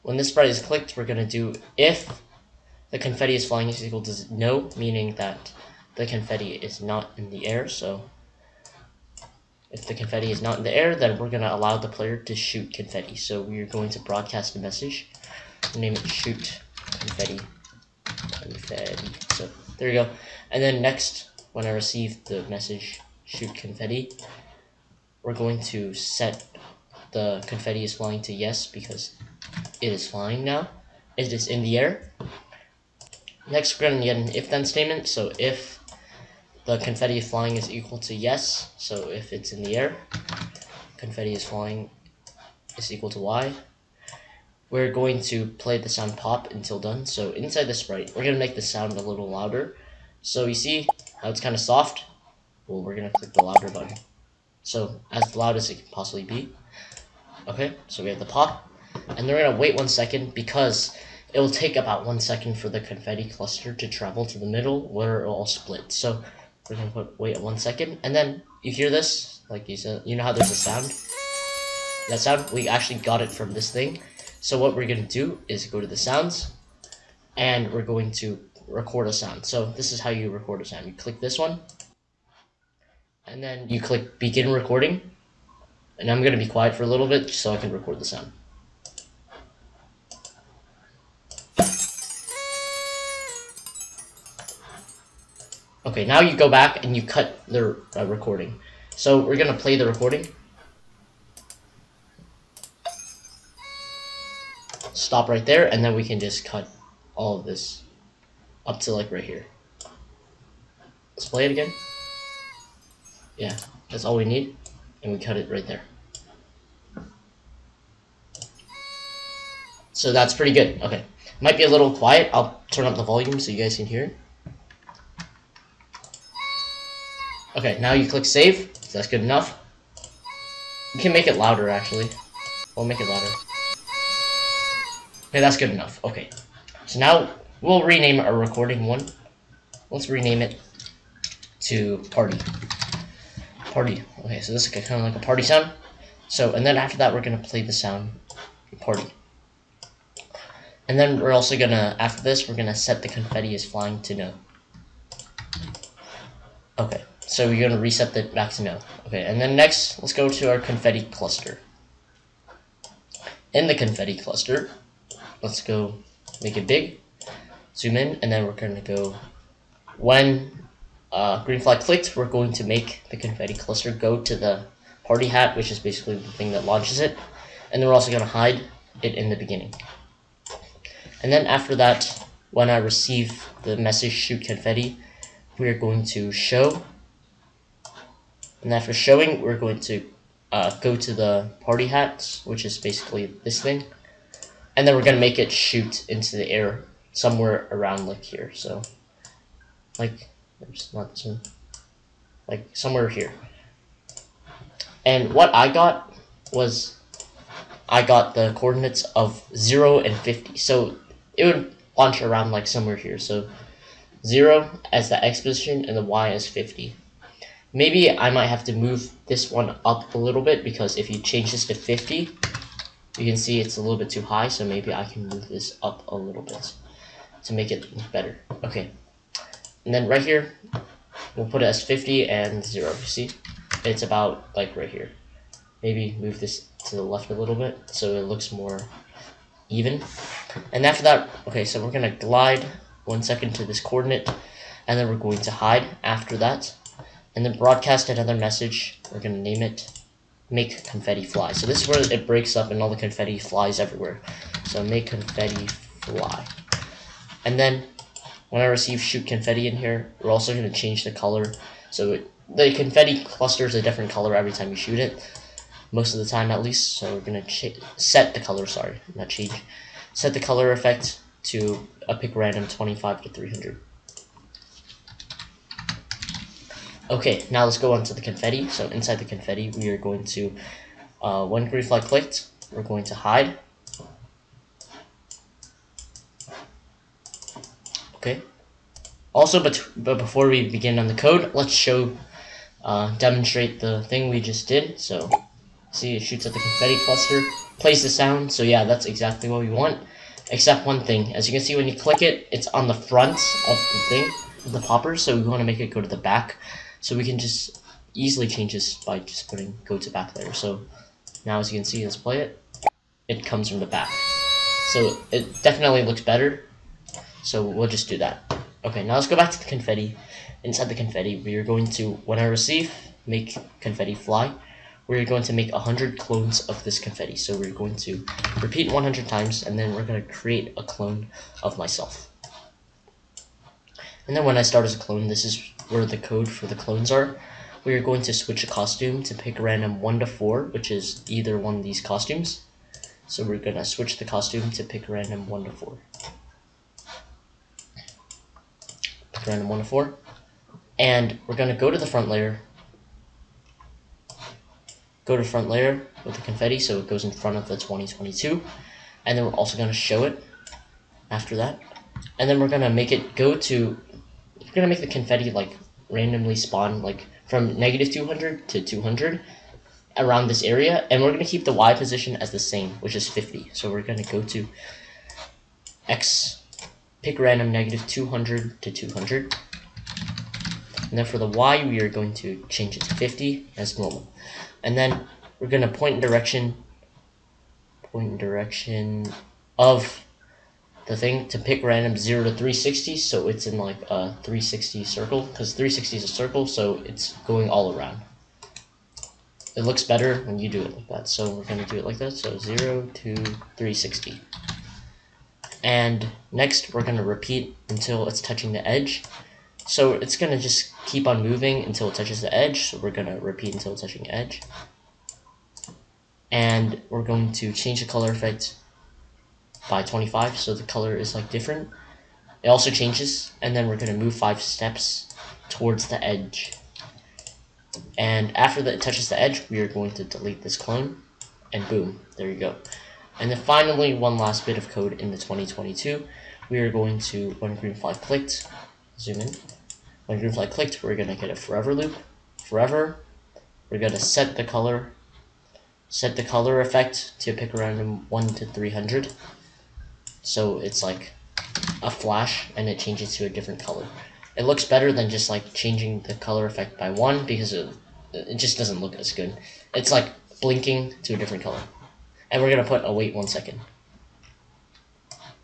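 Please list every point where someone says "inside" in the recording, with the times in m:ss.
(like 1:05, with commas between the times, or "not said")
0:47, 4:38, 5:20.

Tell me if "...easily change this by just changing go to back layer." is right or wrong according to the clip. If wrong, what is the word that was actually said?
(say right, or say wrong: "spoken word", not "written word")
wrong: "putting", not "changing".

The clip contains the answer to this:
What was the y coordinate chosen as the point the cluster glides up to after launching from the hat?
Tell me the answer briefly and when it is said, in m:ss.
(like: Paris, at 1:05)
50, at 3:35.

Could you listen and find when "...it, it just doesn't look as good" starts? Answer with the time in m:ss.
7:37.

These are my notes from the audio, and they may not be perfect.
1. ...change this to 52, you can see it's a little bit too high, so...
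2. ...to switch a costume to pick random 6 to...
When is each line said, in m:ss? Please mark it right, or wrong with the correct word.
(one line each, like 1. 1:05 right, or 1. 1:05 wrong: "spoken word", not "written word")
1. 3:41 wrong: "50", not "52"
2. 5:38 wrong: "1", not "6".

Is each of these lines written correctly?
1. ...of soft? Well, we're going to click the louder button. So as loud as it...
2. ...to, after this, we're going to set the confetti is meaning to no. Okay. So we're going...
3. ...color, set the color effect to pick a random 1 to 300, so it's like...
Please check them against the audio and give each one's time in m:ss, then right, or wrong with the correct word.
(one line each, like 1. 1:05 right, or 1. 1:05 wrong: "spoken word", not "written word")
1. 0:51 right
2. 2:31 wrong: "flying", not "meaning"
3. 7:24 right.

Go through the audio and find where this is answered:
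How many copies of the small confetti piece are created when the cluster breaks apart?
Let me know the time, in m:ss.
5:25.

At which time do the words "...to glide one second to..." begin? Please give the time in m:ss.
4:02.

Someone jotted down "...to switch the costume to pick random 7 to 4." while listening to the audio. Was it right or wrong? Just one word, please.
wrong.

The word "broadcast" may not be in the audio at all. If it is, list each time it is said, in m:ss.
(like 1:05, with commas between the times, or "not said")
0:13, 4:07.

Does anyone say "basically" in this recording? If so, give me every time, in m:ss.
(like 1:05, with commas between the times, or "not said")
2:55, 3:12.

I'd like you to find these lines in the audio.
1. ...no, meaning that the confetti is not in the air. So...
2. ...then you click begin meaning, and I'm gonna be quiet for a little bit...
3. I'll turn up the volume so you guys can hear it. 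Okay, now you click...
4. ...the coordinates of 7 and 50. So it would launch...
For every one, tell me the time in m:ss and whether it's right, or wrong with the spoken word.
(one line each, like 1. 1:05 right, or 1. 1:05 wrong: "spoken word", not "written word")
1. 0:04 right
2. 1:23 wrong: "recording", not "meaning"
3. 2:02 right
4. 3:28 wrong: "0", not "7".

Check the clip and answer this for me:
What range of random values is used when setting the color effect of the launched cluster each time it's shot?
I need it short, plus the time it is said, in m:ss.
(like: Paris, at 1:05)
25 to 300, at 4:32.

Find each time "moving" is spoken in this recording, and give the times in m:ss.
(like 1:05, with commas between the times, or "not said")
6:51.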